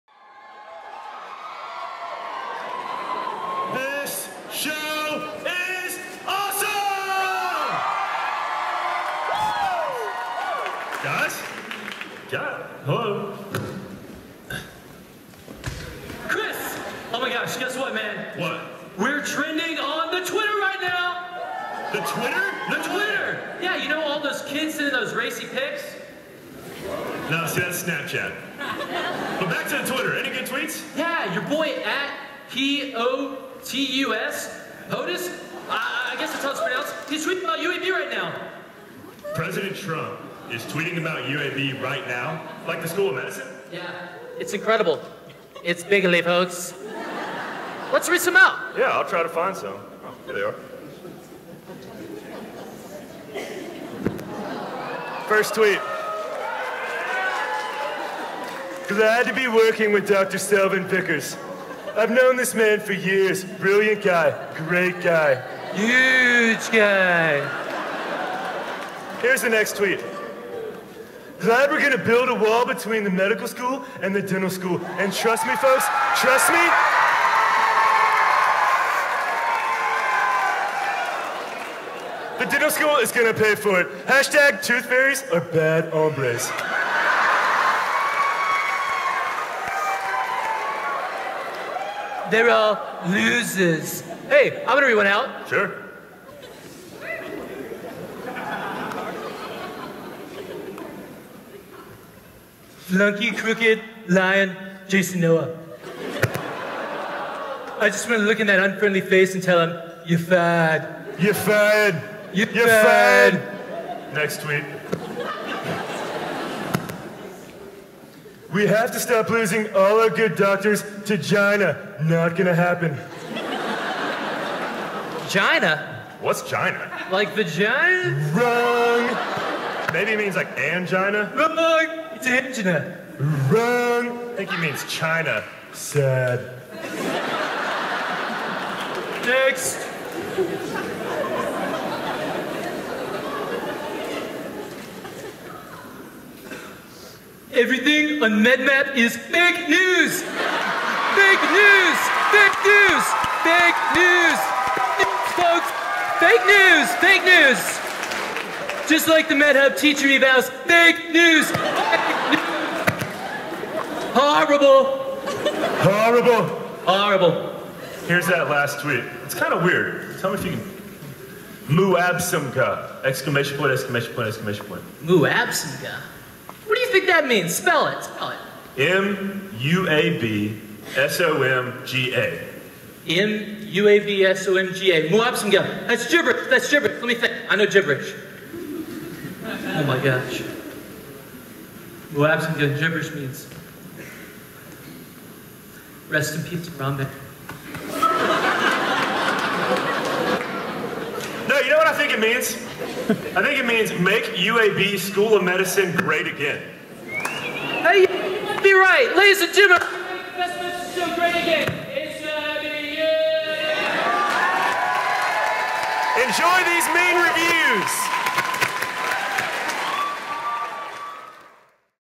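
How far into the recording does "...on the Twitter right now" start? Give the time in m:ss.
0:19.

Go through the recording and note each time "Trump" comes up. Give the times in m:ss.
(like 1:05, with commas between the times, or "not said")
0:39.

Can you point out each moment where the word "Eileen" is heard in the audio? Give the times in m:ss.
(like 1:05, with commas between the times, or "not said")
not said.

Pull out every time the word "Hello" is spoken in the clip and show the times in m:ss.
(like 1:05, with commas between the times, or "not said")
0:12.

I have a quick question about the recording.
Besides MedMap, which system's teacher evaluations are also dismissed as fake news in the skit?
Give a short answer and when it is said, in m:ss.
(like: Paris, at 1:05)
MedHub, at 2:39.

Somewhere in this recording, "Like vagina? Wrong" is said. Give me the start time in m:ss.
2:07.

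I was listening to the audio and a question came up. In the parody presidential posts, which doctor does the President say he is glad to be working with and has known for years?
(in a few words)
Selwyn Vickers.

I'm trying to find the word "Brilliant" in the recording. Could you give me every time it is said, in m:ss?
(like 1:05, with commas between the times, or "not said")
1:03.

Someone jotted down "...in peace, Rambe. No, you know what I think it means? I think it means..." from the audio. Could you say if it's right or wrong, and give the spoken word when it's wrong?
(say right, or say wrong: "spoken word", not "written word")
right.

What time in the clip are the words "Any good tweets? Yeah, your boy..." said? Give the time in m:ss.
0:30.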